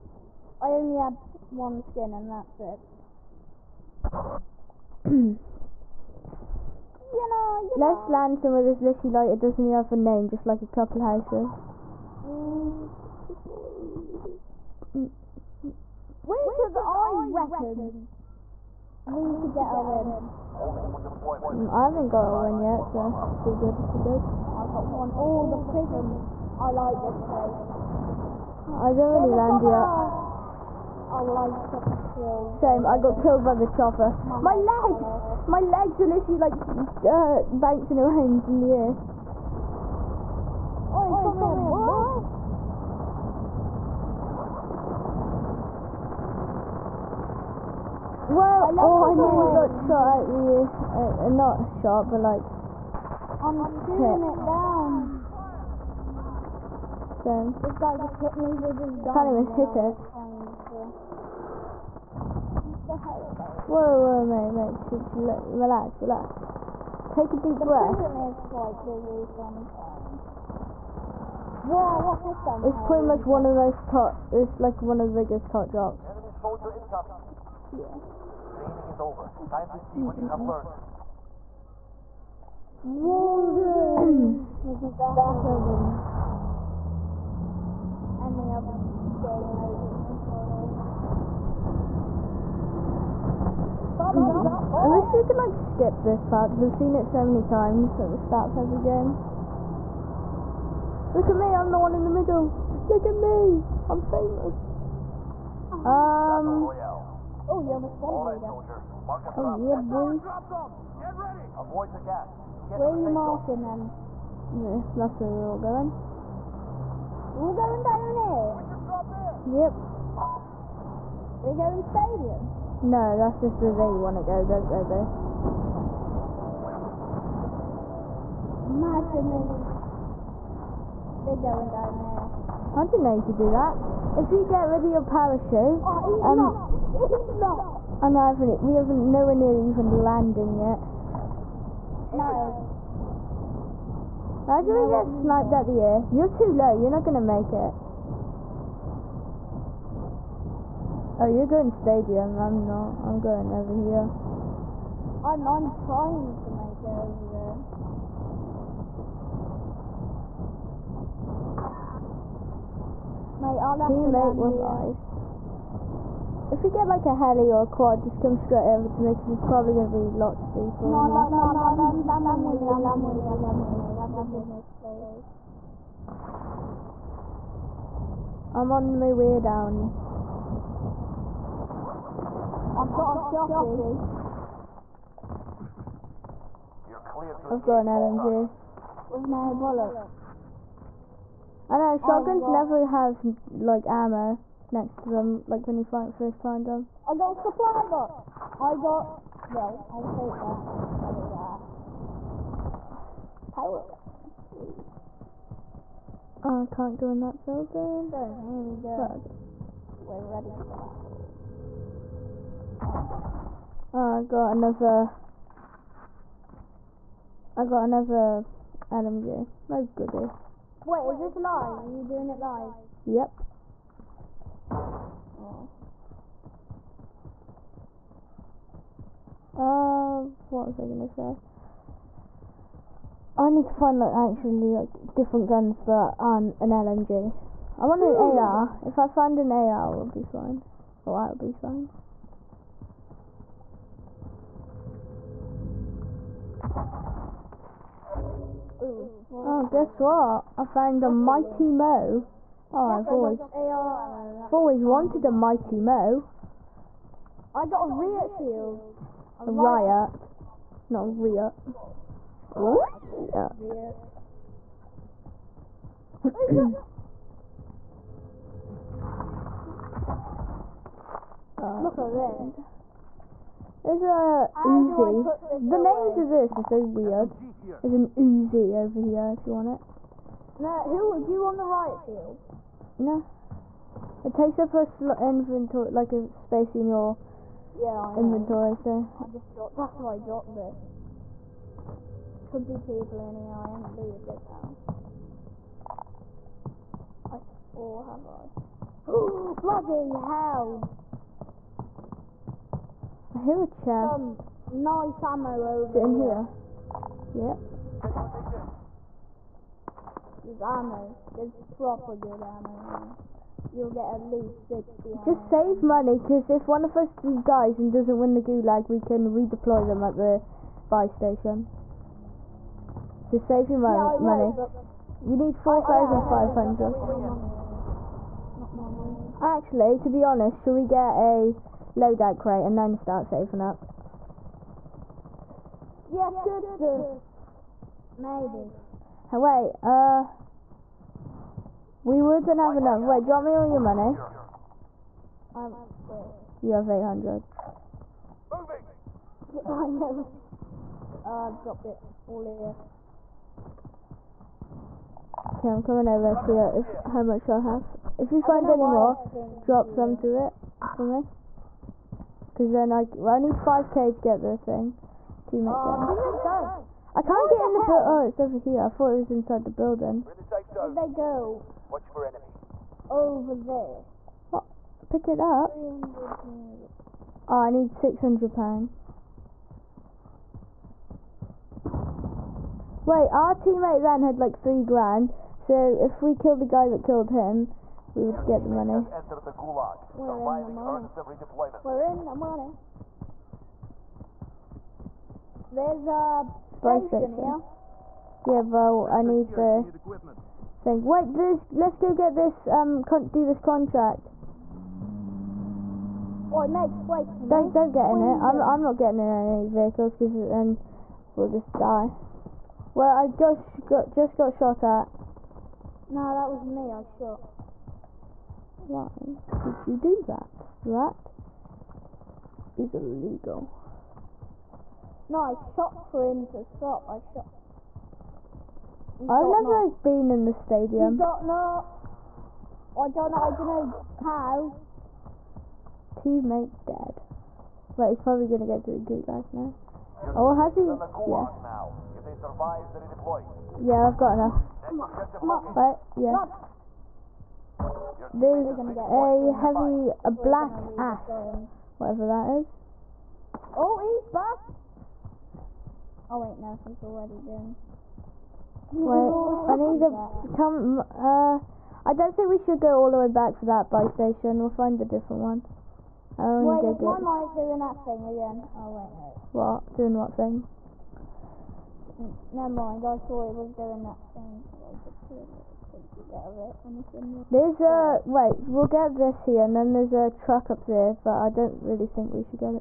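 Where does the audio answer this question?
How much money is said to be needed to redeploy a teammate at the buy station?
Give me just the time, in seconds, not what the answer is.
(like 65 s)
325 s.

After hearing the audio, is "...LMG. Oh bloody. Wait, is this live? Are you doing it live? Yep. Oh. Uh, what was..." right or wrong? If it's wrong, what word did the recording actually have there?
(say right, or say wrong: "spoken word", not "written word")
wrong: "goody", not "bloody".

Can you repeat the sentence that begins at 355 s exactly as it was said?
Okay, I'm coming over and see if, how much I'll have.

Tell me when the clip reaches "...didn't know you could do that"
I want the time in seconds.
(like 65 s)
132 s.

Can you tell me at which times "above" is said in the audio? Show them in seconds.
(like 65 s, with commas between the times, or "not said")
not said.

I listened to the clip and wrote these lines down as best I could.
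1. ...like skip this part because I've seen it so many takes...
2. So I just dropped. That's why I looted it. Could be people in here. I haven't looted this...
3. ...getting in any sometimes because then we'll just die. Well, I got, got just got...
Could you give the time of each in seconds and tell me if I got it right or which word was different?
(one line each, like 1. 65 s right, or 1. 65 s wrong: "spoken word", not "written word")
1. 95 s wrong: "times", not "takes"
2. 288 s wrong: "dropped", not "looted"
3. 408 s wrong: "vehicles", not "sometimes".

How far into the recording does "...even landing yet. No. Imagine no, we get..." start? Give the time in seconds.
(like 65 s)
139 s.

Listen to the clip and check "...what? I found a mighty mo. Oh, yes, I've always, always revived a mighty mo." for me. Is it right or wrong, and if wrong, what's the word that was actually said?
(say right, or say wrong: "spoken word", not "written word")
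wrong: "wanted", not "revived".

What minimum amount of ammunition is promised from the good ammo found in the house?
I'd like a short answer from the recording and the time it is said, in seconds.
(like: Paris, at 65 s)
60, at 314 s.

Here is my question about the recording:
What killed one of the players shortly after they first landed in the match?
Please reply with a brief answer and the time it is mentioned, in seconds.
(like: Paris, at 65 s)
The chopper, at 33 s.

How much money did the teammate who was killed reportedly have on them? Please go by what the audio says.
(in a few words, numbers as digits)
Three grand.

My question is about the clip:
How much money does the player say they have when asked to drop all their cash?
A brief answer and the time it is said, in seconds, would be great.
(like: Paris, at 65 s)
800, at 346 s.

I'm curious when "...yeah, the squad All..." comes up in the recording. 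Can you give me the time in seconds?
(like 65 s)
107 s.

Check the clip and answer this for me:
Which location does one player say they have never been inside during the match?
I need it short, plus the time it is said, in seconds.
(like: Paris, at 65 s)
The stadium, at 430 s.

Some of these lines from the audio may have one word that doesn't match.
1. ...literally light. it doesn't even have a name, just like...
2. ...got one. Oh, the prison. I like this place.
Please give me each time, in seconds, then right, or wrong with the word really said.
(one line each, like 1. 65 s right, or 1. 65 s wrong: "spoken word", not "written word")
1. 8 s right
2. 24 s right.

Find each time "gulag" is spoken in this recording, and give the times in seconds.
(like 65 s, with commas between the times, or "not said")
318 s, 438 s.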